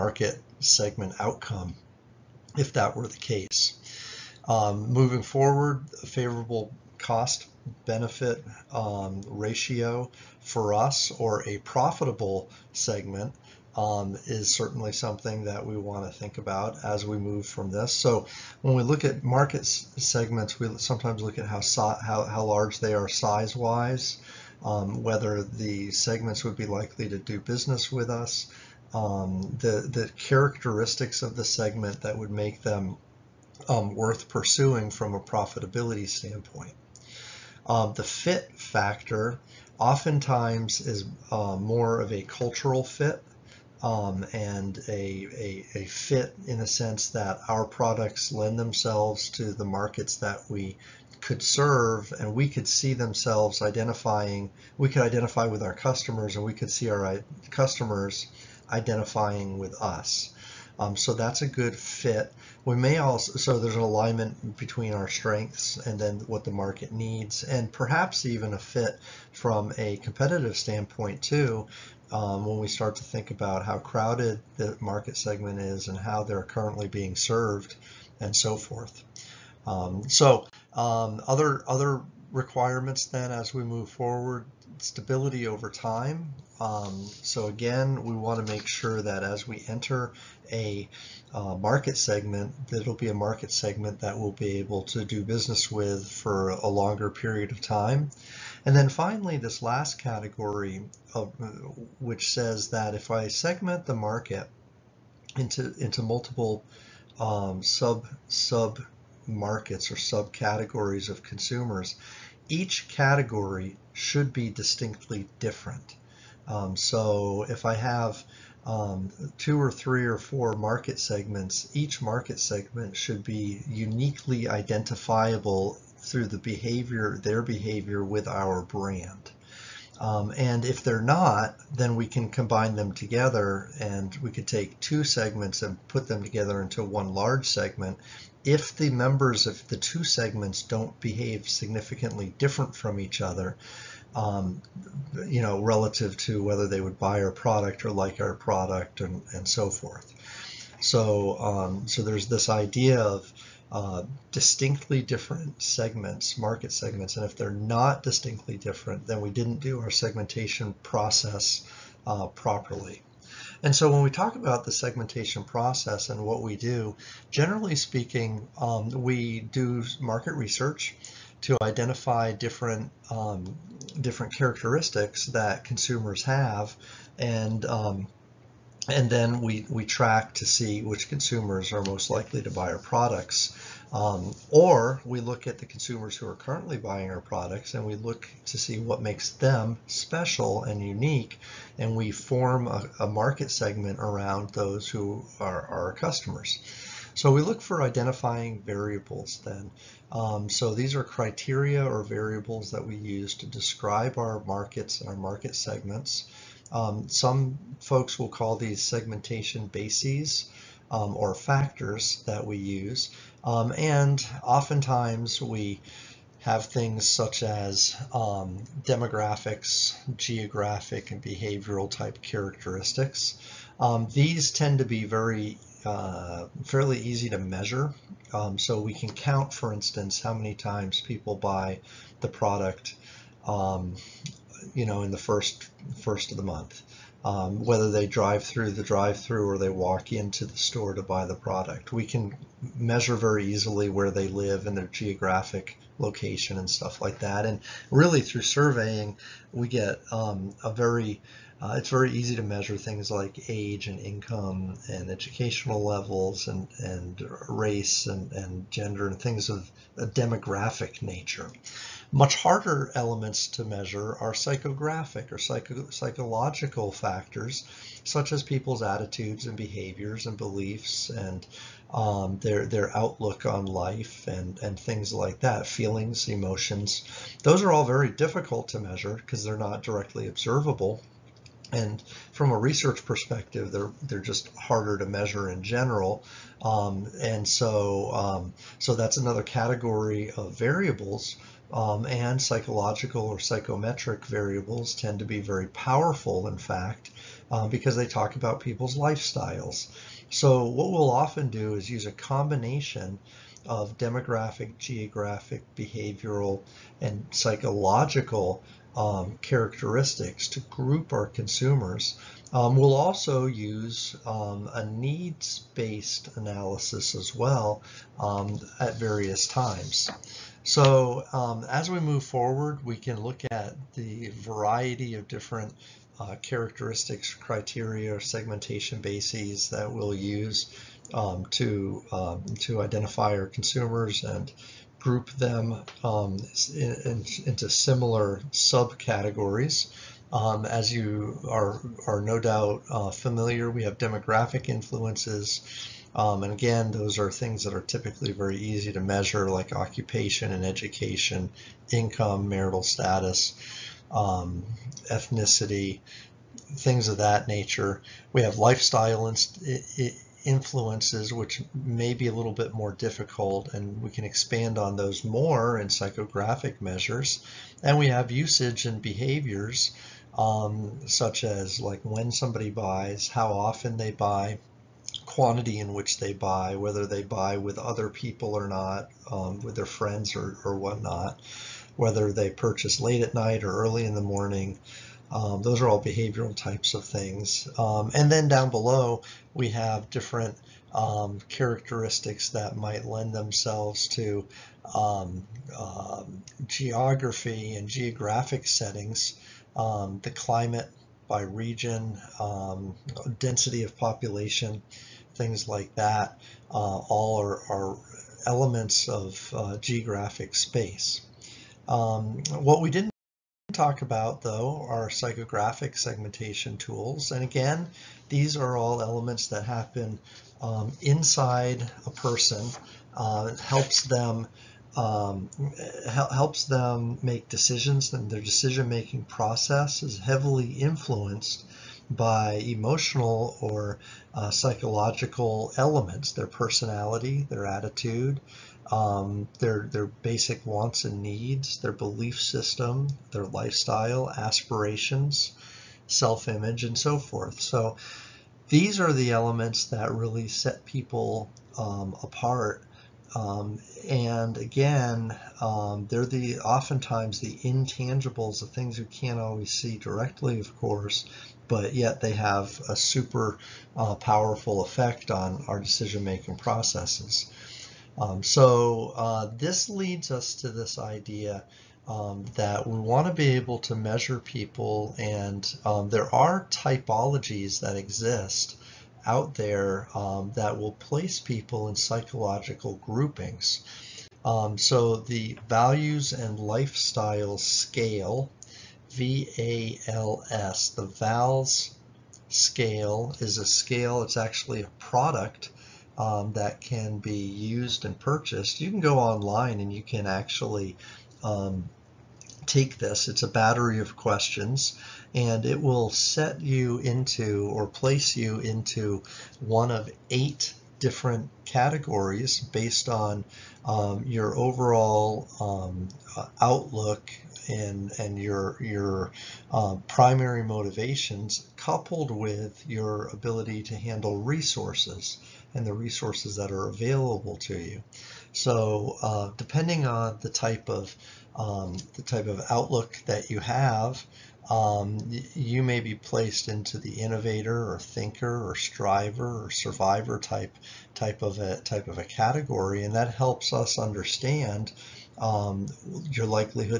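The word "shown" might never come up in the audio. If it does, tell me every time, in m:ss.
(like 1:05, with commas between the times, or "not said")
not said.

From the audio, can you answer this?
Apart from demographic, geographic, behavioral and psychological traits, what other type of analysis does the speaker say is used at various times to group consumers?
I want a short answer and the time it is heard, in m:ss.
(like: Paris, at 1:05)
needs-based analysis, at 5:14.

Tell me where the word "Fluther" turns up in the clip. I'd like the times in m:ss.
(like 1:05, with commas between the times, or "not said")
not said.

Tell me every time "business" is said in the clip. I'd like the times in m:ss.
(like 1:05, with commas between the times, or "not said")
0:27, 1:35.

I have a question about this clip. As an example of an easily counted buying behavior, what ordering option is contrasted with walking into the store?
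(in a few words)
drive-through.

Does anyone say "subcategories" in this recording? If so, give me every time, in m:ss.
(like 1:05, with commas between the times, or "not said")
1:49, 5:38.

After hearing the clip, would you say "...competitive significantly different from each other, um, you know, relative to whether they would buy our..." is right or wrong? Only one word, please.
wrong.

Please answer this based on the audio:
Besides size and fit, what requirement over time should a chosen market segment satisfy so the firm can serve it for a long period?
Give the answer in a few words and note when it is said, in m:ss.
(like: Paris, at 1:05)
stability over time, at 1:24.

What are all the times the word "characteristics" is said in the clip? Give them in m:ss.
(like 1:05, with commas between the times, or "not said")
0:30, 2:54, 3:42, 5:09, 5:26, 6:31.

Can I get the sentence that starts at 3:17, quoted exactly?
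So we look for identifying variables then.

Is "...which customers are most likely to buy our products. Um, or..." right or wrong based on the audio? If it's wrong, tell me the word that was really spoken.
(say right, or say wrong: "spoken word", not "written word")
wrong: "consumers", not "customers".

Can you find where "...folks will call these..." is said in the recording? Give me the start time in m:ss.
3:27.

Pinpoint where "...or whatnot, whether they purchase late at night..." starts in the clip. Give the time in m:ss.
6:20.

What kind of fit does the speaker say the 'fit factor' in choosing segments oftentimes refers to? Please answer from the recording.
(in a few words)
cultural fit.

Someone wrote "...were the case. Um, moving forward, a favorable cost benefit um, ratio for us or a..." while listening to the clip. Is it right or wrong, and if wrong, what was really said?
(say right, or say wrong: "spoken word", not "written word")
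right.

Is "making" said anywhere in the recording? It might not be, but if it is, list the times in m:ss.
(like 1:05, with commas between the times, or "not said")
7:08, 7:45.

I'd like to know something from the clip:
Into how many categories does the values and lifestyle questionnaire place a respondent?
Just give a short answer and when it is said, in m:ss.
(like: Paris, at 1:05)
8, at 8:30.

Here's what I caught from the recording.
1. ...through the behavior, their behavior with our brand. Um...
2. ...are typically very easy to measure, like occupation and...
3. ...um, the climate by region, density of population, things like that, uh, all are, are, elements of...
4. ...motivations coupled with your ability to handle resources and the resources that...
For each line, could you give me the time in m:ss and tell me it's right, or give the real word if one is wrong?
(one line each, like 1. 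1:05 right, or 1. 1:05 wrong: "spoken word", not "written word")
1. 2:06 right
2. 5:47 right
3. 6:39 right
4. 8:40 right.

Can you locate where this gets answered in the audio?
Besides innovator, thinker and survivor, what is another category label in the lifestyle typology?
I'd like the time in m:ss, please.
8:58.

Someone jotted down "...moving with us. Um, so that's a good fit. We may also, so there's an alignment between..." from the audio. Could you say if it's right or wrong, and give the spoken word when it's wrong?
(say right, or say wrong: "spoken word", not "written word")
wrong: "identifying", not "moving".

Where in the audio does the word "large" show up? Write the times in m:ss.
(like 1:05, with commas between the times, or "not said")
0:22, 2:17.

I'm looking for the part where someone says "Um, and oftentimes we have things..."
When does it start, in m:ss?
3:33.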